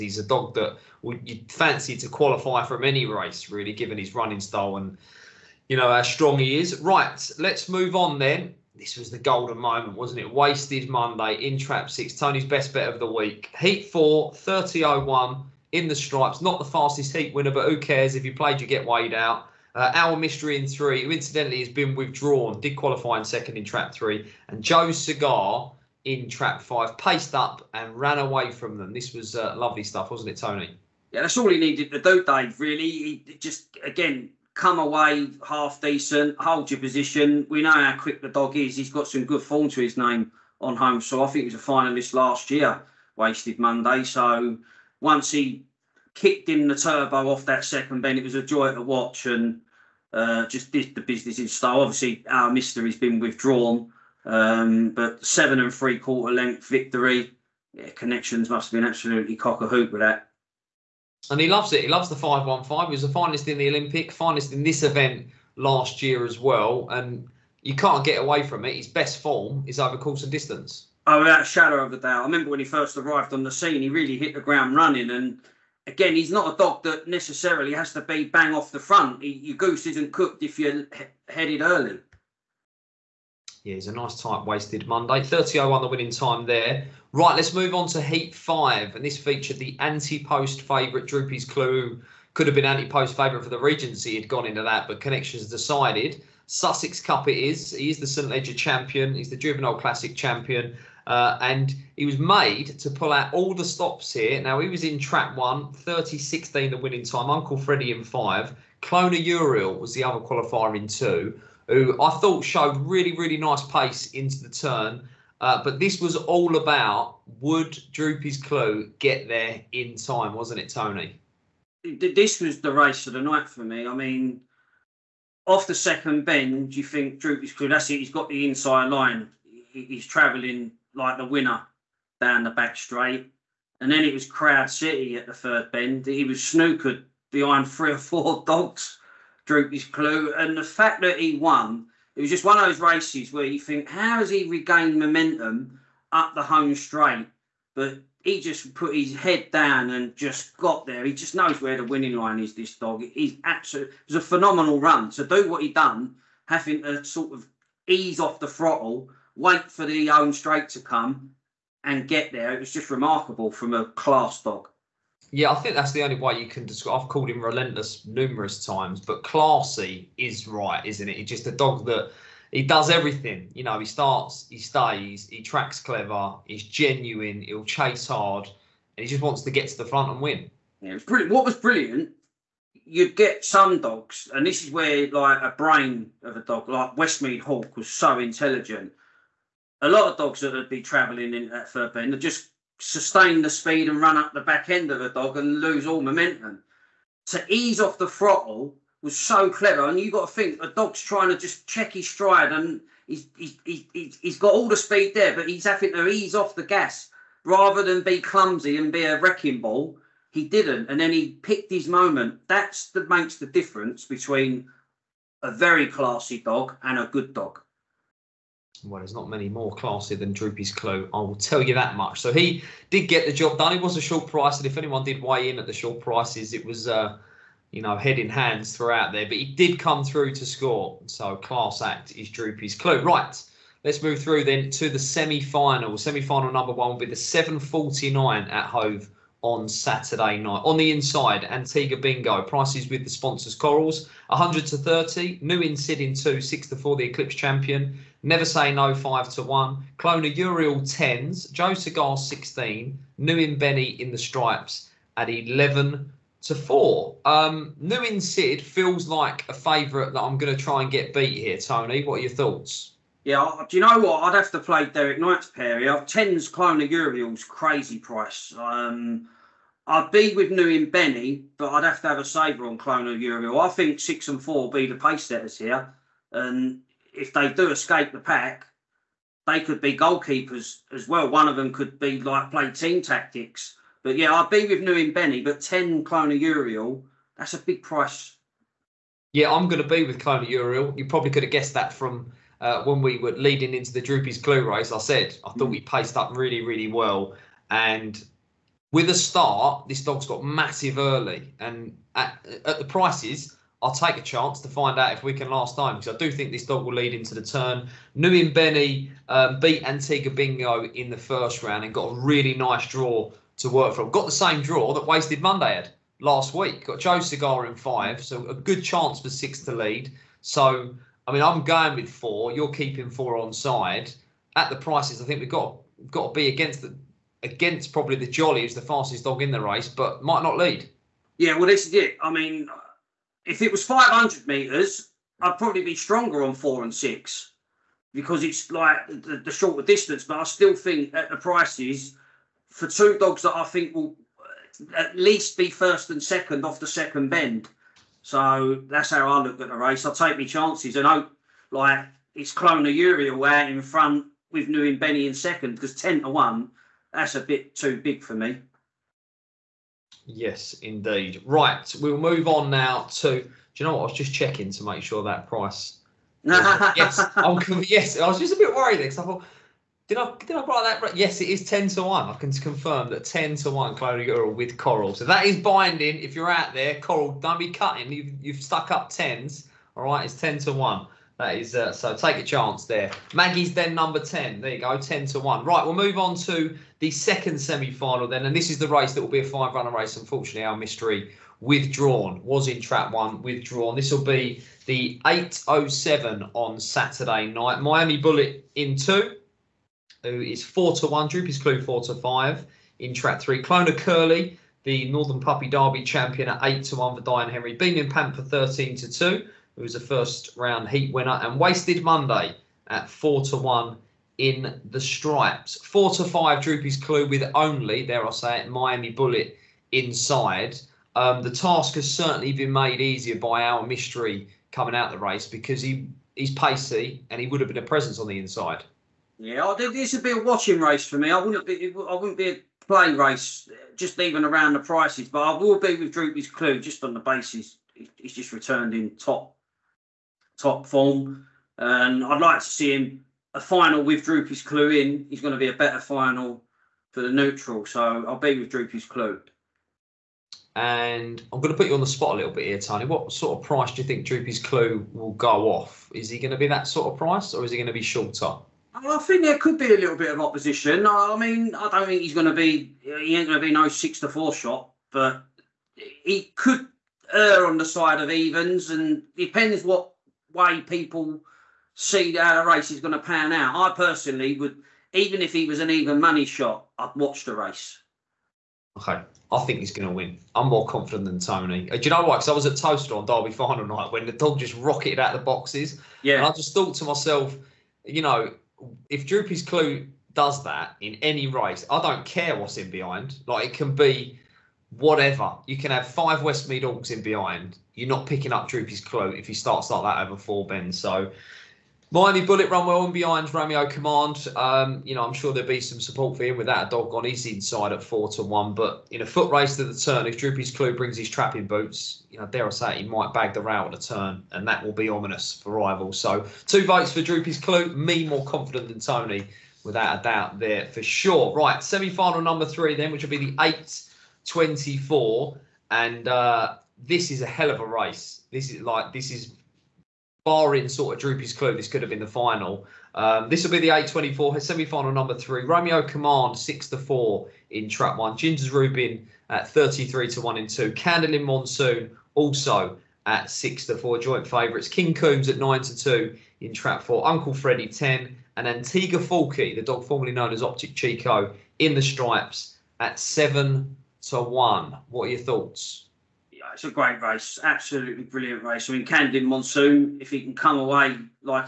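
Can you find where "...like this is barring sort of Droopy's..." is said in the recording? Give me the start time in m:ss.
8:48.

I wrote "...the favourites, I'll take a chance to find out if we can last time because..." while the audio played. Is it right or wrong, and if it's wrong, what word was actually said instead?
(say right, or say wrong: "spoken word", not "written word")
wrong: "prices", not "favourites".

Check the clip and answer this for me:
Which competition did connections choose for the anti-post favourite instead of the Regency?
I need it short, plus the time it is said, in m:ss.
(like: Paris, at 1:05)
Sussex Cup, at 1:36.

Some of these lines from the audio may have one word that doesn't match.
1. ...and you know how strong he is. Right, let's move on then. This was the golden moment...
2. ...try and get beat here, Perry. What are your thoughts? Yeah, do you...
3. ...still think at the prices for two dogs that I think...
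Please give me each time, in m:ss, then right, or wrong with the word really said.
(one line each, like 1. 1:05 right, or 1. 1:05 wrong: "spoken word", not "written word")
1. 0:04 right
2. 4:20 wrong: "Tony", not "Perry"
3. 5:40 right.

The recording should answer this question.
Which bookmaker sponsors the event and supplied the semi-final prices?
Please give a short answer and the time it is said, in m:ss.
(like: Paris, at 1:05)
Corals, at 4:03.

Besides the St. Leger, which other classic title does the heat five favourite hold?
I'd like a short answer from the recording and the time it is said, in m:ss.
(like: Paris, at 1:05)
Juvenile Classic, at 1:39.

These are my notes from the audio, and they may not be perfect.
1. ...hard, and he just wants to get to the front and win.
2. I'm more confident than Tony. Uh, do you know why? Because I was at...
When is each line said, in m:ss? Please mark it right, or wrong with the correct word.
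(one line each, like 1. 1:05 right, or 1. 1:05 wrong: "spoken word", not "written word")
1. 2:58 right
2. 8:00 right.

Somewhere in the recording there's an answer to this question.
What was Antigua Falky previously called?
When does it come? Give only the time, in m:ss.
9:10.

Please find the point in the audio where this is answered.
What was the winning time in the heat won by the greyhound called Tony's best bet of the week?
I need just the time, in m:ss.
0:14.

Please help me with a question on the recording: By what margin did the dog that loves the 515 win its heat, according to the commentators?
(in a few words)
7¾ lengths.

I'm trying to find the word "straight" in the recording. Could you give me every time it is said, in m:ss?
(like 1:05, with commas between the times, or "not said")
2:12, 2:26, 2:40.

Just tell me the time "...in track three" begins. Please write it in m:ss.
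6:42.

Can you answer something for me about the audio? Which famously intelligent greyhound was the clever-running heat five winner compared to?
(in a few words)
Westmead Hawk.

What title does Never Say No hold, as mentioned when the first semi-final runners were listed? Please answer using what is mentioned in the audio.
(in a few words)
Eclipse Champion.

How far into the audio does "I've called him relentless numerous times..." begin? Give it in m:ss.
2:47.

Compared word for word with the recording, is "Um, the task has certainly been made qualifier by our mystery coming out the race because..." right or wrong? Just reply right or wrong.
wrong.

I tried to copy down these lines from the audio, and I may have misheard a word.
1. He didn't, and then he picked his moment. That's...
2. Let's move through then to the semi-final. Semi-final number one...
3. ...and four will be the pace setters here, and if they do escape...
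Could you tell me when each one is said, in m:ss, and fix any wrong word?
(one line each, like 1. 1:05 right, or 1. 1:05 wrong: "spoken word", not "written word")
1. 3:30 right
2. 3:53 right
3. 4:34 right.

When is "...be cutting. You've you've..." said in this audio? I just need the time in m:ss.
6:17.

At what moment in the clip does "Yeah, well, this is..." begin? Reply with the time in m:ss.
5:31.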